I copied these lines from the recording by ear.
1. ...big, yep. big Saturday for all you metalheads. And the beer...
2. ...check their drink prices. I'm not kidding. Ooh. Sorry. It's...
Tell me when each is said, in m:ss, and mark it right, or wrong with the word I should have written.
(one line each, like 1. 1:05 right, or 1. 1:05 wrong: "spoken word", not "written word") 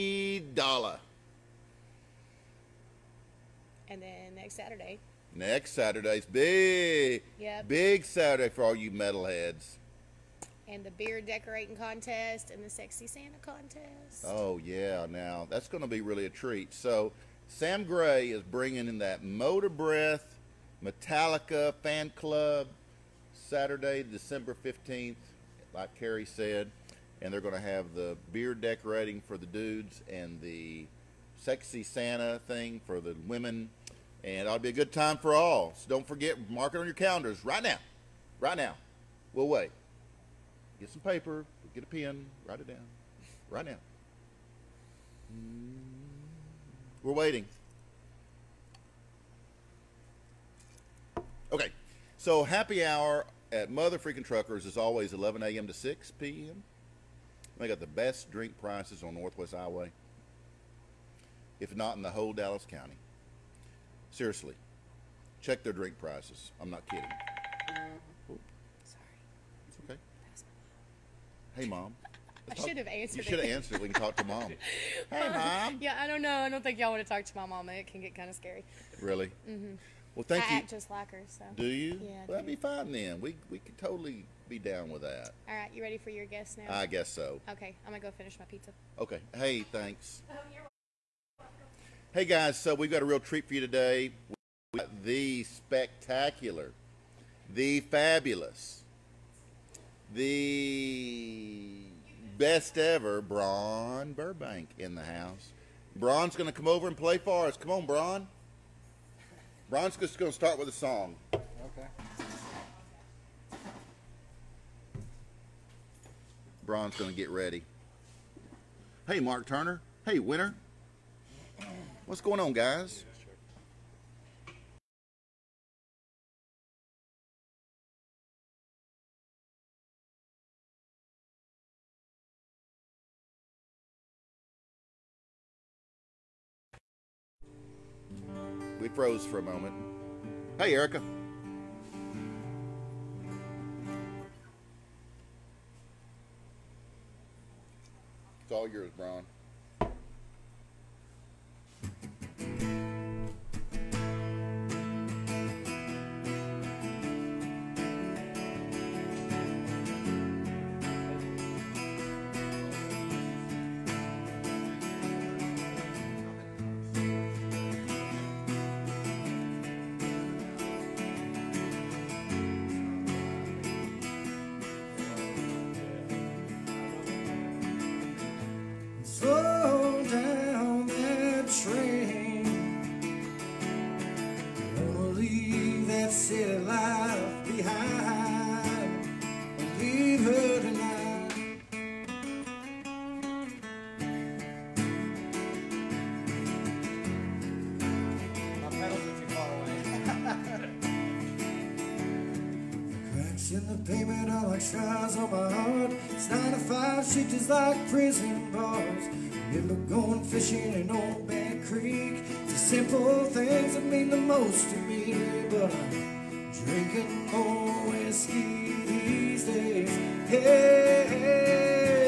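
1. 0:06 right
2. 1:05 right.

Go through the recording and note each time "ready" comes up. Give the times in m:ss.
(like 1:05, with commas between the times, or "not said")
1:25, 1:57.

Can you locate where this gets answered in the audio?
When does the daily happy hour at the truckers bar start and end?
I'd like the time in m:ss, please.
0:55.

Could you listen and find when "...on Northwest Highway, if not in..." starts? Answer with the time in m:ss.
0:59.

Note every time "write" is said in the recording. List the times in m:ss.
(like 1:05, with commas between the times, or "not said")
0:42.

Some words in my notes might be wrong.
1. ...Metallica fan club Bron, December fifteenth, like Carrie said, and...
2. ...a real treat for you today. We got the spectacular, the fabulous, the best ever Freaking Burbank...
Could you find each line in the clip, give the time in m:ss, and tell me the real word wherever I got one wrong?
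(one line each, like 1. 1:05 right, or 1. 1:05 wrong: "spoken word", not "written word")
1. 0:20 wrong: "Saturday", not "Bron"
2. 1:33 wrong: "Bron", not "Freaking".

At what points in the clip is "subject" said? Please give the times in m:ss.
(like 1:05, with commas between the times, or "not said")
not said.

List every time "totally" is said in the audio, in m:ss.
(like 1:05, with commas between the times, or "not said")
1:23.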